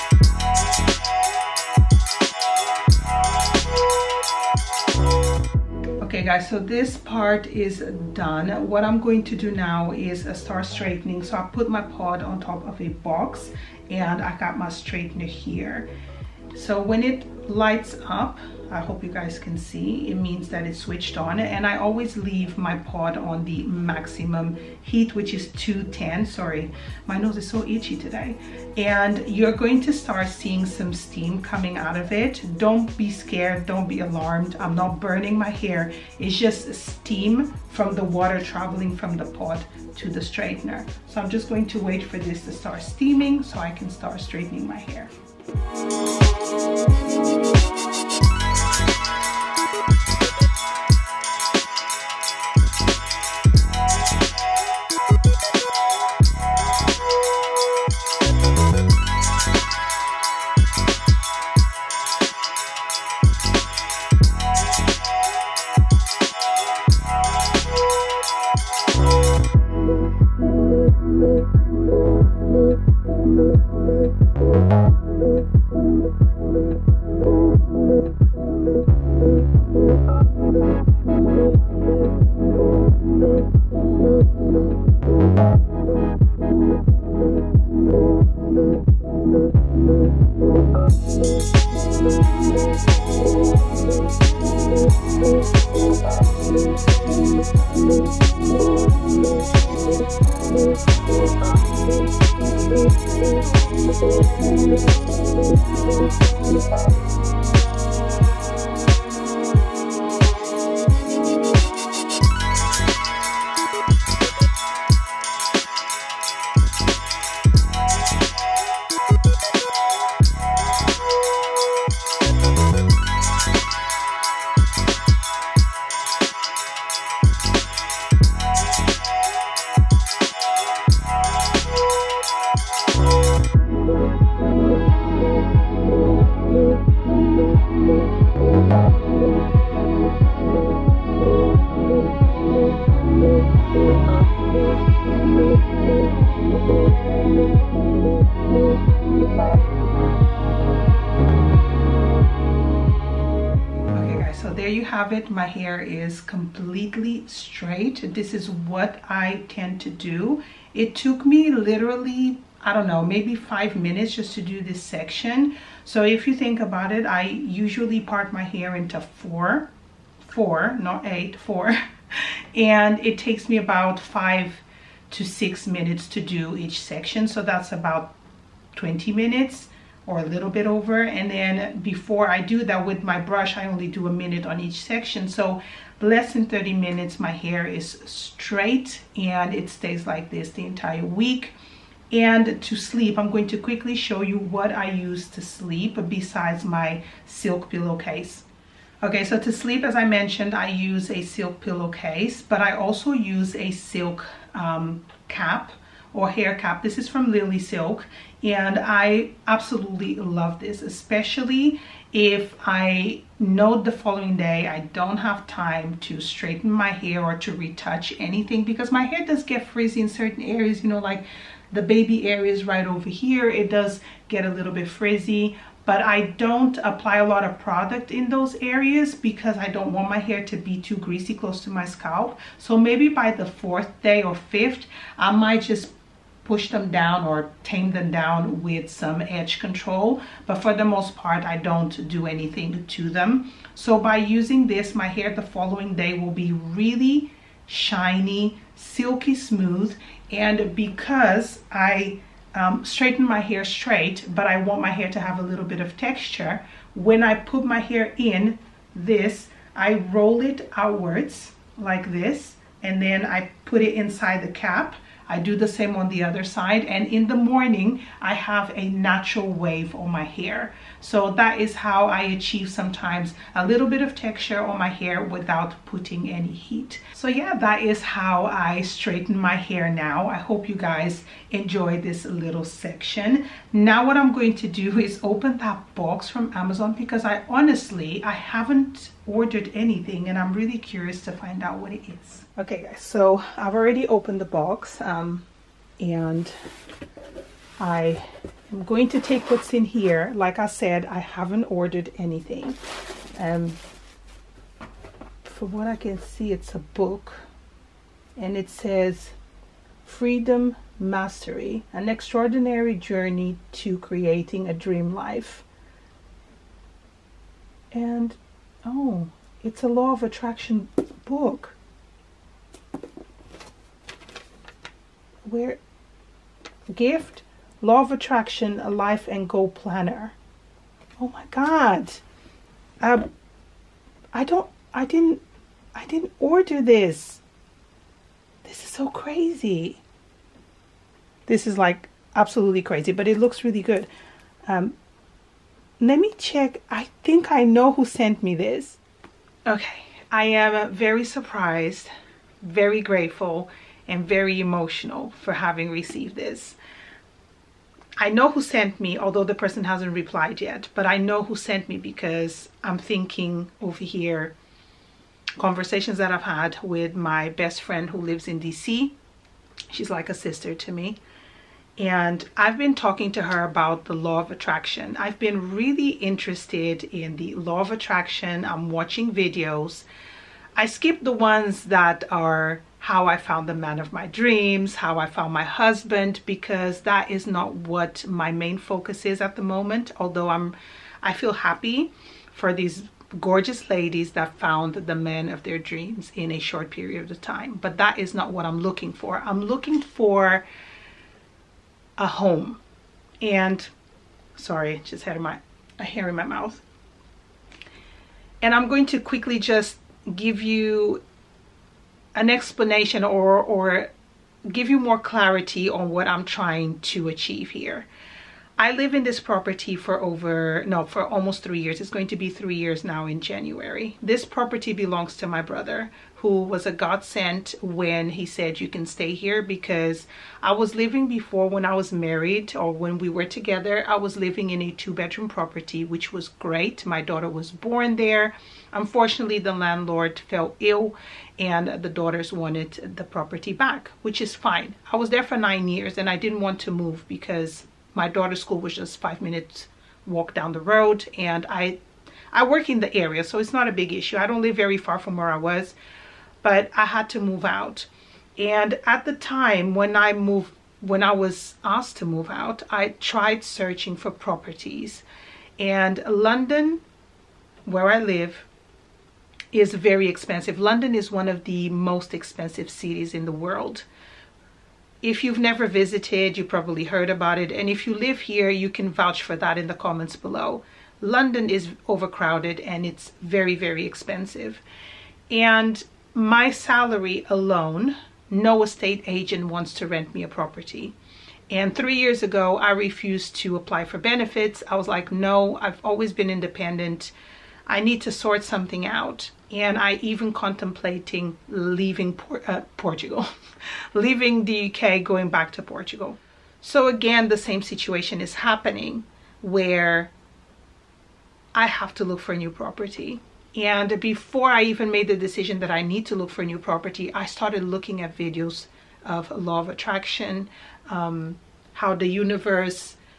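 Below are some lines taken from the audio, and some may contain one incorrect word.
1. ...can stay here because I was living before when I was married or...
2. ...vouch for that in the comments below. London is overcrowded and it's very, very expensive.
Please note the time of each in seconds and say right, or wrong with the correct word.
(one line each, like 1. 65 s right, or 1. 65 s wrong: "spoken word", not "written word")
1. 428 s right
2. 479 s right.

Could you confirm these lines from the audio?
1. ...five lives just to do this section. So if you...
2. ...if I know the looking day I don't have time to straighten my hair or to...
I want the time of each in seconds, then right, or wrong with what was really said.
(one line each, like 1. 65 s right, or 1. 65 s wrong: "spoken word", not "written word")
1. 163 s wrong: "minutes", not "lives"
2. 212 s wrong: "following", not "looking".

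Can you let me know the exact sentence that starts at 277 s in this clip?
So yeah, that is how I straighten my hair now.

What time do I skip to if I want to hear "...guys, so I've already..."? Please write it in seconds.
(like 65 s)
292 s.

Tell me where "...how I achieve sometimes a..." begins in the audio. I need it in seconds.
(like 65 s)
271 s.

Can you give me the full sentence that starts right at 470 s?
London is one of the most expensive cities in the world.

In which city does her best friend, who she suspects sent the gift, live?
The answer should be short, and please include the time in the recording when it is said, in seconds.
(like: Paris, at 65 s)
DC, at 368 s.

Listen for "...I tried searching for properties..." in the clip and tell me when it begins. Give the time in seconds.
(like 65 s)
462 s.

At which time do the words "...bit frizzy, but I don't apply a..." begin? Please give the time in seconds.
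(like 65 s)
224 s.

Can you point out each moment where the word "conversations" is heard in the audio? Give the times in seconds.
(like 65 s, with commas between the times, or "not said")
365 s.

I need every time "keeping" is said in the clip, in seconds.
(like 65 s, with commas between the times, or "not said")
not said.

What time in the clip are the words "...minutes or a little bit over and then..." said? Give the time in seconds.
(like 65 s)
179 s.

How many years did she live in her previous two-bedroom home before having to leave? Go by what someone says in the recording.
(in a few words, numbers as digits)
9.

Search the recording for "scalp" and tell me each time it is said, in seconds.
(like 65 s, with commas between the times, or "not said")
231 s.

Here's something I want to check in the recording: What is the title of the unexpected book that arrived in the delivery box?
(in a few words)
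Freedom Mastery.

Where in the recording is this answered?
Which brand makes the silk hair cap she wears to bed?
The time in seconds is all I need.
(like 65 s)
207 s.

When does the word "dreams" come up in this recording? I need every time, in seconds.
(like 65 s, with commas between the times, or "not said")
314 s, 384 s, 395 s.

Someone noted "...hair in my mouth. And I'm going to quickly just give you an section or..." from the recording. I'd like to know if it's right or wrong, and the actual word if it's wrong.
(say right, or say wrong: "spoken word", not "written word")
wrong: "explanation", not "section".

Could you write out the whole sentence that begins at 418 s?
I live in this property for over, no, for almost three years.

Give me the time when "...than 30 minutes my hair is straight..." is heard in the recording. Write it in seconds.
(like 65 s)
186 s.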